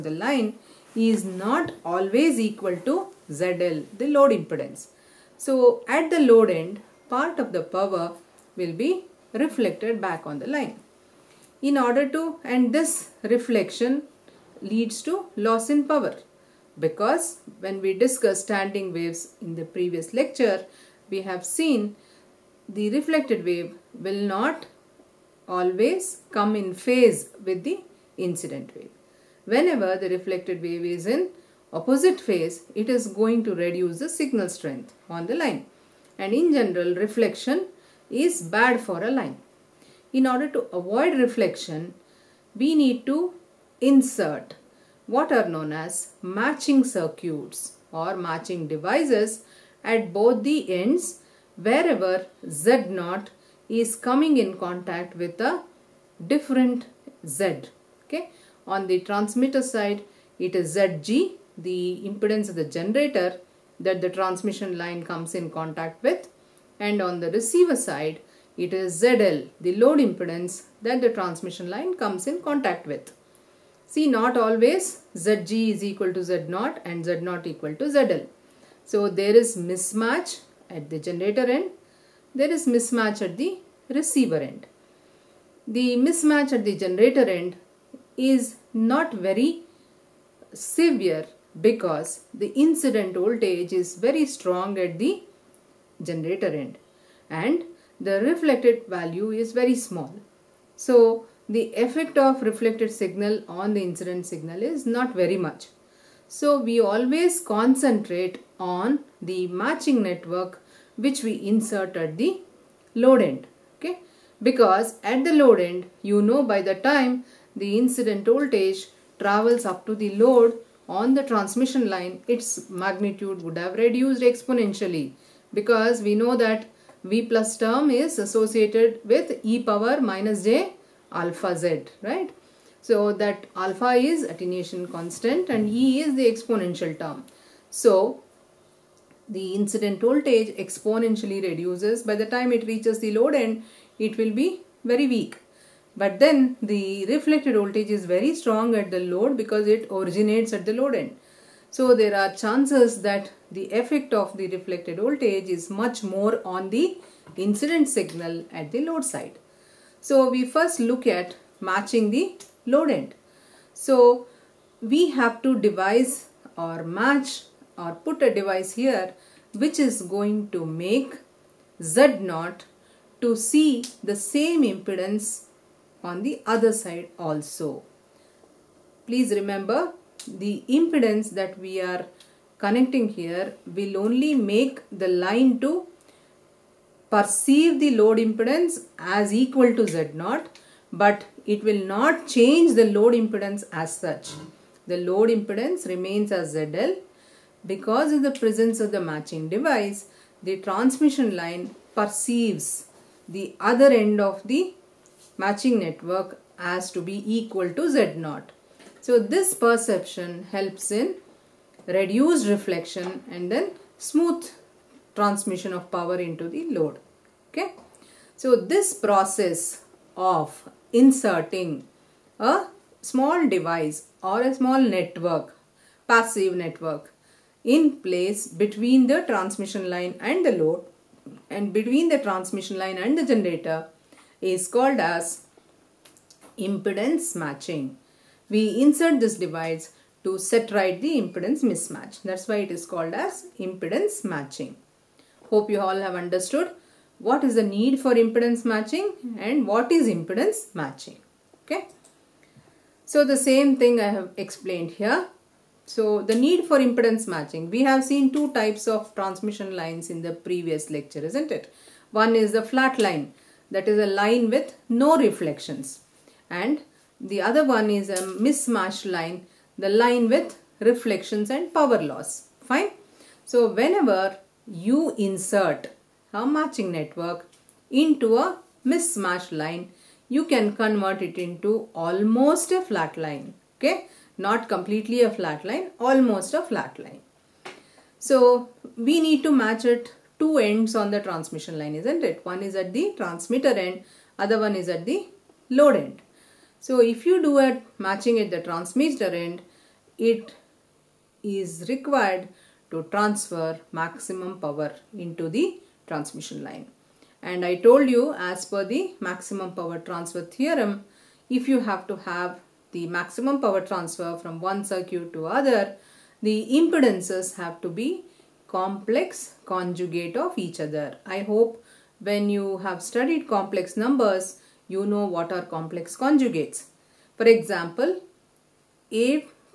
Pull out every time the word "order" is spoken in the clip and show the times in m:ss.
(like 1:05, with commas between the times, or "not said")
0:11, 0:40.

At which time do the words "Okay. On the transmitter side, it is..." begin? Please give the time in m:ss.
0:58.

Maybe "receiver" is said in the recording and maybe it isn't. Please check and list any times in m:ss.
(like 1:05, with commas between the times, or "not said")
1:07, 1:23.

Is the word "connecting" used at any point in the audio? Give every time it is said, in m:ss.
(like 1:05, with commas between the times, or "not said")
3:02.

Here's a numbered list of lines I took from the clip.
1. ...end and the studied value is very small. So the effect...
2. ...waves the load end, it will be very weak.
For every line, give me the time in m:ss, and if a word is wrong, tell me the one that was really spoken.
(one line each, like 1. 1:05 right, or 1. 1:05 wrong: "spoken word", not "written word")
1. 1:36 wrong: "reflected", not "studied"
2. 2:22 wrong: "reaches", not "waves".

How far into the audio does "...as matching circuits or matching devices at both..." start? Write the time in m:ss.
0:45.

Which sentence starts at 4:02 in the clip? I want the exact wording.
That's why it is called as impedance matching.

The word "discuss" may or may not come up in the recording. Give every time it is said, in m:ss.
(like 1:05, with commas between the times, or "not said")
0:17.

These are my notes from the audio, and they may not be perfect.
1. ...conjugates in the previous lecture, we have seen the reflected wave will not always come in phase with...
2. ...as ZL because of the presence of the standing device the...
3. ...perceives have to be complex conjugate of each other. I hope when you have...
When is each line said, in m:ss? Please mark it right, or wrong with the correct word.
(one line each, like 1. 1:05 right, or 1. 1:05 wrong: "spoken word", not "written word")
1. 0:18 wrong: "waves", not "conjugates"
2. 3:16 wrong: "matching", not "standing"
3. 5:16 wrong: "impedances", not "perceives".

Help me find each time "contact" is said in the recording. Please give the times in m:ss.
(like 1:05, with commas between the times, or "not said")
0:54, 1:05, 1:12.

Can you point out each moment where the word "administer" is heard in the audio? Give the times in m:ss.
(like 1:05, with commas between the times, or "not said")
not said.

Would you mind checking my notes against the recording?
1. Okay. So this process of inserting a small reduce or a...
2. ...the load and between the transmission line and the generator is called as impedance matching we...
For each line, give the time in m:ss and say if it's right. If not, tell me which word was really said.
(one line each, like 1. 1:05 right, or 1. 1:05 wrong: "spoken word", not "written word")
1. 3:37 wrong: "device", not "reduce"
2. 3:50 right.